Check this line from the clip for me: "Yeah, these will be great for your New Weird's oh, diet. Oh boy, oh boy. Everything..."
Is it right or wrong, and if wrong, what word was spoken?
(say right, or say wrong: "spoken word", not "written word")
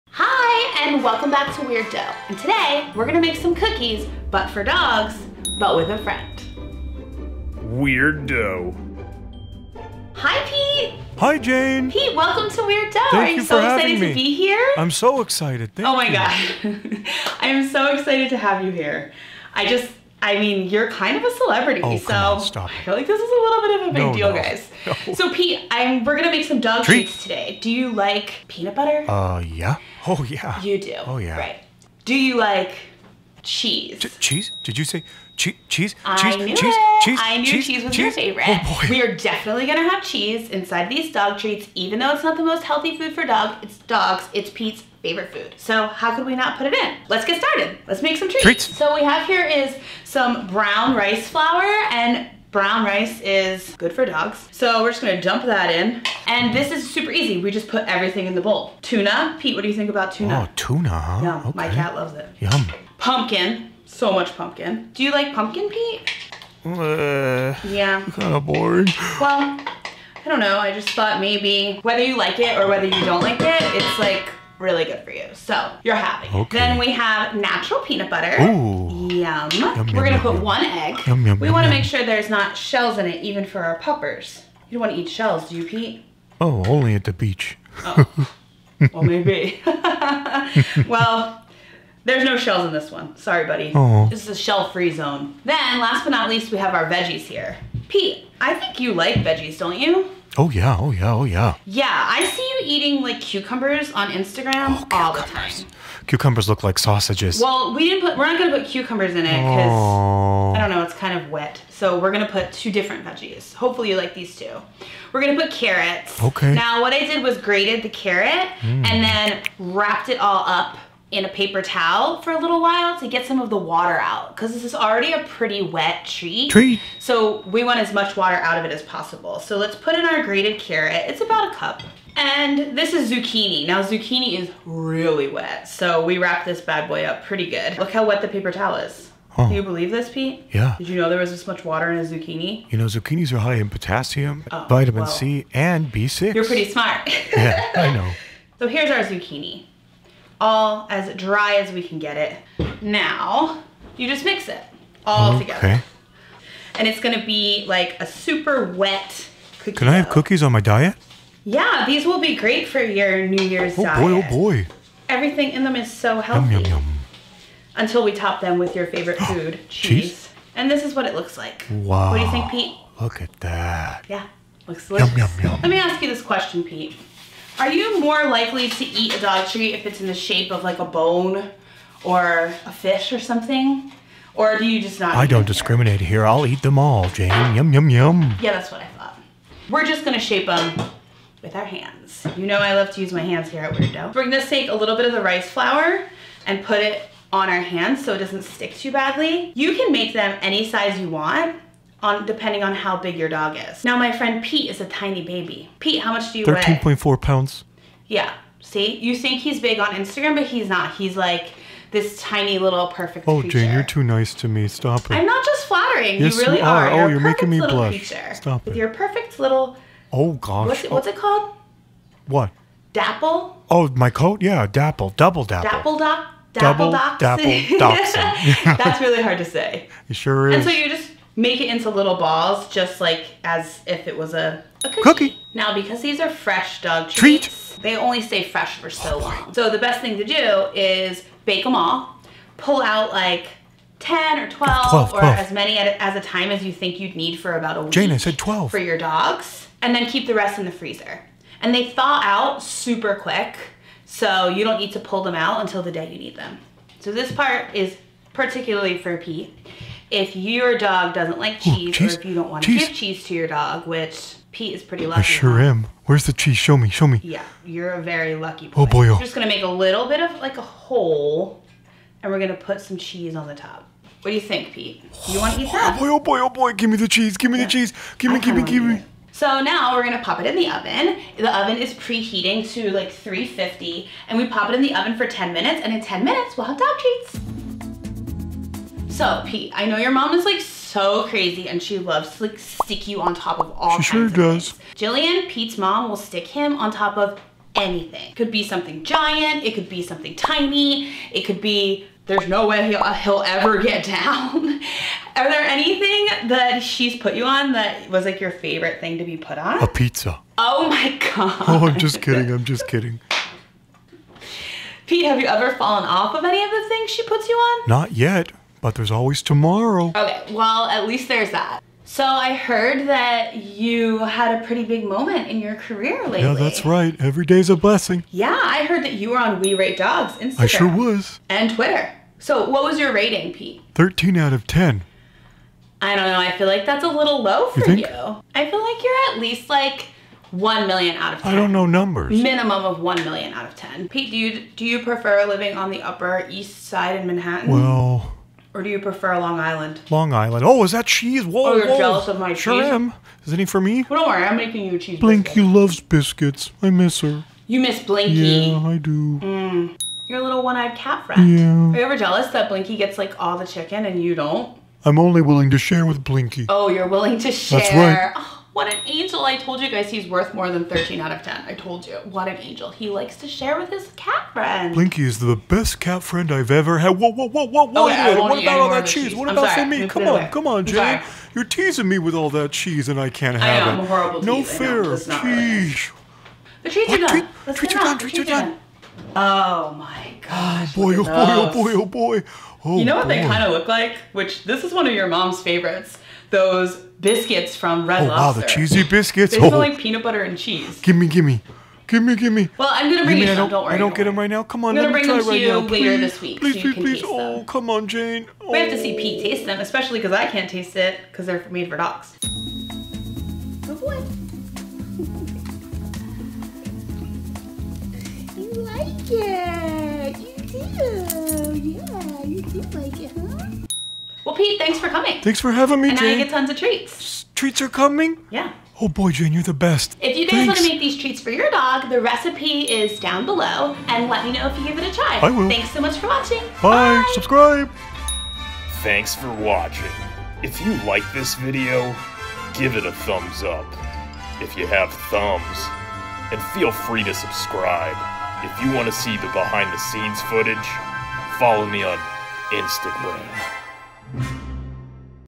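wrong: "Year", not "Weird".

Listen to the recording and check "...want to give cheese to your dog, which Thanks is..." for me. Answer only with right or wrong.
wrong.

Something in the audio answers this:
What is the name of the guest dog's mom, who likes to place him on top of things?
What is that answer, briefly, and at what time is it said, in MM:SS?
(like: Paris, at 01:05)
Jillian, at 04:54.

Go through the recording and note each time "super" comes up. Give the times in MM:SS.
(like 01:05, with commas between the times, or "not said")
00:56, 02:38, 04:12.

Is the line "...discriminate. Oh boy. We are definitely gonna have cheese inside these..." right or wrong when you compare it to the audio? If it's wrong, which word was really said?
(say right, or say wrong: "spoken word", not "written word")
wrong: "favorite", not "discriminate".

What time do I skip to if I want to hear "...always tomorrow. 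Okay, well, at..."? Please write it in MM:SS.
05:19.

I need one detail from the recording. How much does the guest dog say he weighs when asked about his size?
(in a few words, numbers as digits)
13.4 pounds.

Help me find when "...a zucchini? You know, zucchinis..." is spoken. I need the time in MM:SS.
02:21.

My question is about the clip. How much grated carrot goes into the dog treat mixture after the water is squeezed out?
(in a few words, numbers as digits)
About a cup.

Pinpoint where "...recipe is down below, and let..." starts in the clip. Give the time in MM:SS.
07:12.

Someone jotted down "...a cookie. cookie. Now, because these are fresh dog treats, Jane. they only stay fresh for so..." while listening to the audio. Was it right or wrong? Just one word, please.
wrong.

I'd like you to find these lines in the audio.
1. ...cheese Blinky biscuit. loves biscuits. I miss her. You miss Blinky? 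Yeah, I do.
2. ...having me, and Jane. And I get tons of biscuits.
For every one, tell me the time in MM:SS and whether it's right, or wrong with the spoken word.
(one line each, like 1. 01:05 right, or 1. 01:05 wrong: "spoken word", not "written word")
1. 05:54 right
2. 07:05 wrong: "treats", not "biscuits".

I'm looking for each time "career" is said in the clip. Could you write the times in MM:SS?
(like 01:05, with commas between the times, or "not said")
05:25.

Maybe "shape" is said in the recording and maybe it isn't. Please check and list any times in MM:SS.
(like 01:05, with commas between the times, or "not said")
03:00, 03:10.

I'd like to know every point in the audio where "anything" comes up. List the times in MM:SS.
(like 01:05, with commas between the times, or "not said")
04:57, 05:05.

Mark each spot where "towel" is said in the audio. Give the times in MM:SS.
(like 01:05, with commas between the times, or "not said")
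02:01, 02:18.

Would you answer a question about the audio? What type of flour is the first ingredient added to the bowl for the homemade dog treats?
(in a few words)
Brown rice flour.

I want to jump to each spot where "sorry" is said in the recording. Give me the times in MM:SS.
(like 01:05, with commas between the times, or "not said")
01:33, 06:19.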